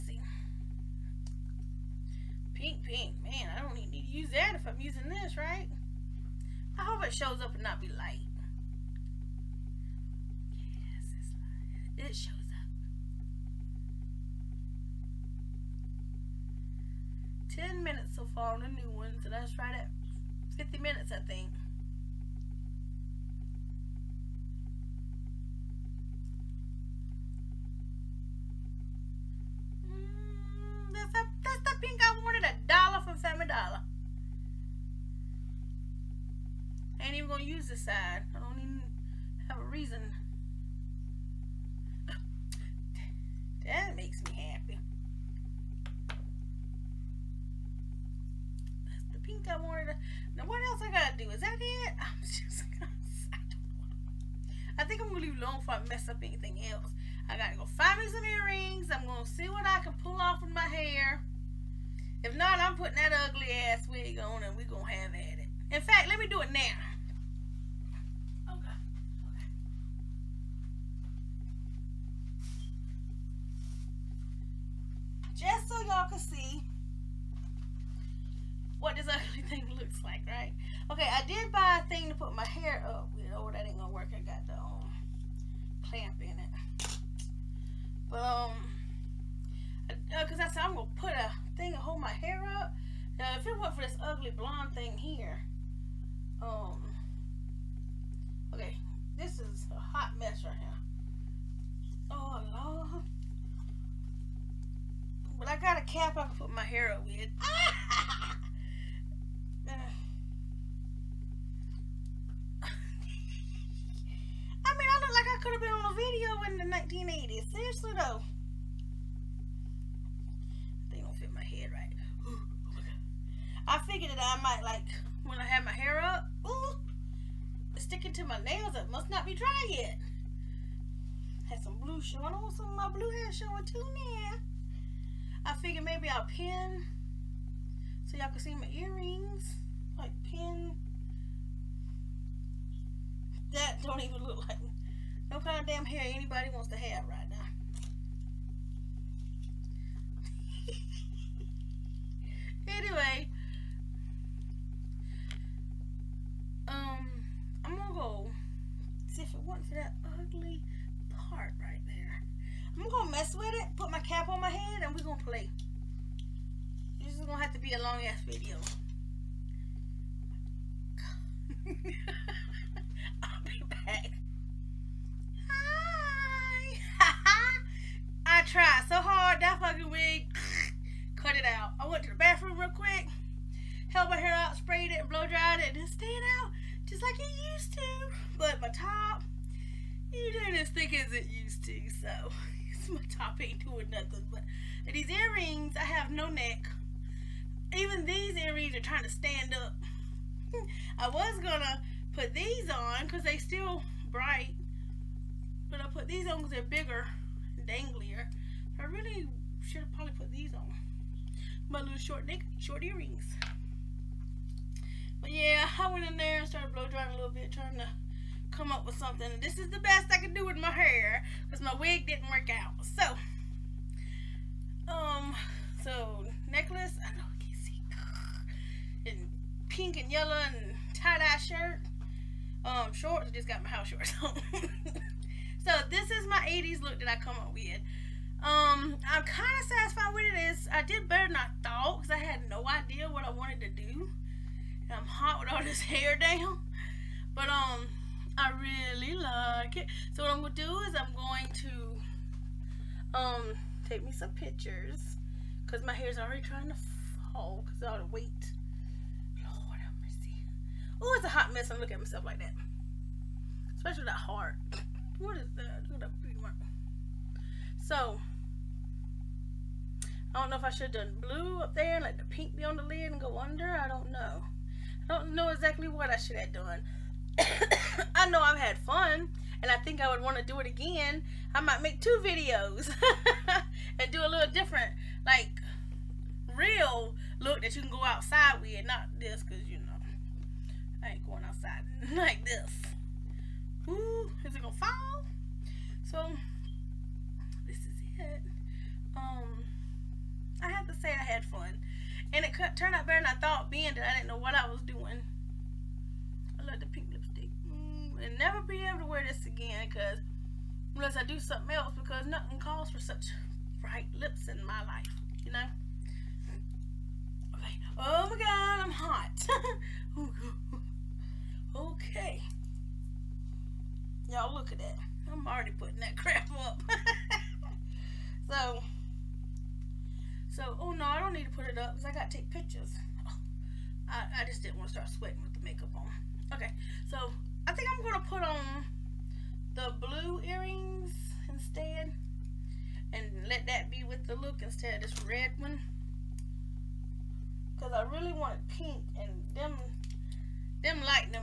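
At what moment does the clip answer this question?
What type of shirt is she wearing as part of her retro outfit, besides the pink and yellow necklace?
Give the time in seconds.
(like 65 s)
230 s.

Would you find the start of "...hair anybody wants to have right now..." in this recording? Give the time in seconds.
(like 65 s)
145 s.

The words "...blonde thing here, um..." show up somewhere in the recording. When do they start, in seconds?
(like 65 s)
94 s.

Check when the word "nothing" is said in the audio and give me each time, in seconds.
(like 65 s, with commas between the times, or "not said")
193 s, 312 s.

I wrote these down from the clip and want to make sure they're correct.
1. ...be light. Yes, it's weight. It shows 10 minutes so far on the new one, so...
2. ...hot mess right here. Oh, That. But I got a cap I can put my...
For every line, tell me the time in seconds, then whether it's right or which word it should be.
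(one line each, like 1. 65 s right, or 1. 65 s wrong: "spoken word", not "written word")
1. 7 s wrong: "light", not "weight"
2. 99 s wrong: "Lord", not "That".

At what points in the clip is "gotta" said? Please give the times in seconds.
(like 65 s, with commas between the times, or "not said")
50 s, 57 s.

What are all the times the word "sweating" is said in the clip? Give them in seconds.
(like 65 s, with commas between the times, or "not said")
335 s.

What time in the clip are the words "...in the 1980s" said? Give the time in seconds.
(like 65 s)
116 s.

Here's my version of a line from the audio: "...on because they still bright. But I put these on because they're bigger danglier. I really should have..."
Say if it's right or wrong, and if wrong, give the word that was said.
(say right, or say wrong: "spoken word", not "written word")
right.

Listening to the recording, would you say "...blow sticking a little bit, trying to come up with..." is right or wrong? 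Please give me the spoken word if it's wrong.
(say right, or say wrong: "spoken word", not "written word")
wrong: "drying", not "sticking".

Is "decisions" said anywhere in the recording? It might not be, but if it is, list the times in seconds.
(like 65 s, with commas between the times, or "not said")
not said.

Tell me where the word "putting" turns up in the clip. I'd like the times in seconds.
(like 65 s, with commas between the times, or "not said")
62 s, 325 s.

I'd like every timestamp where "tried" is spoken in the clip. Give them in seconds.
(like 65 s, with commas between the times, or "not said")
178 s.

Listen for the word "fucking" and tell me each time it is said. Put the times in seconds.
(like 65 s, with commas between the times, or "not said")
179 s.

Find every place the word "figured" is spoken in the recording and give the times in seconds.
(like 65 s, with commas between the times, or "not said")
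123 s, 135 s.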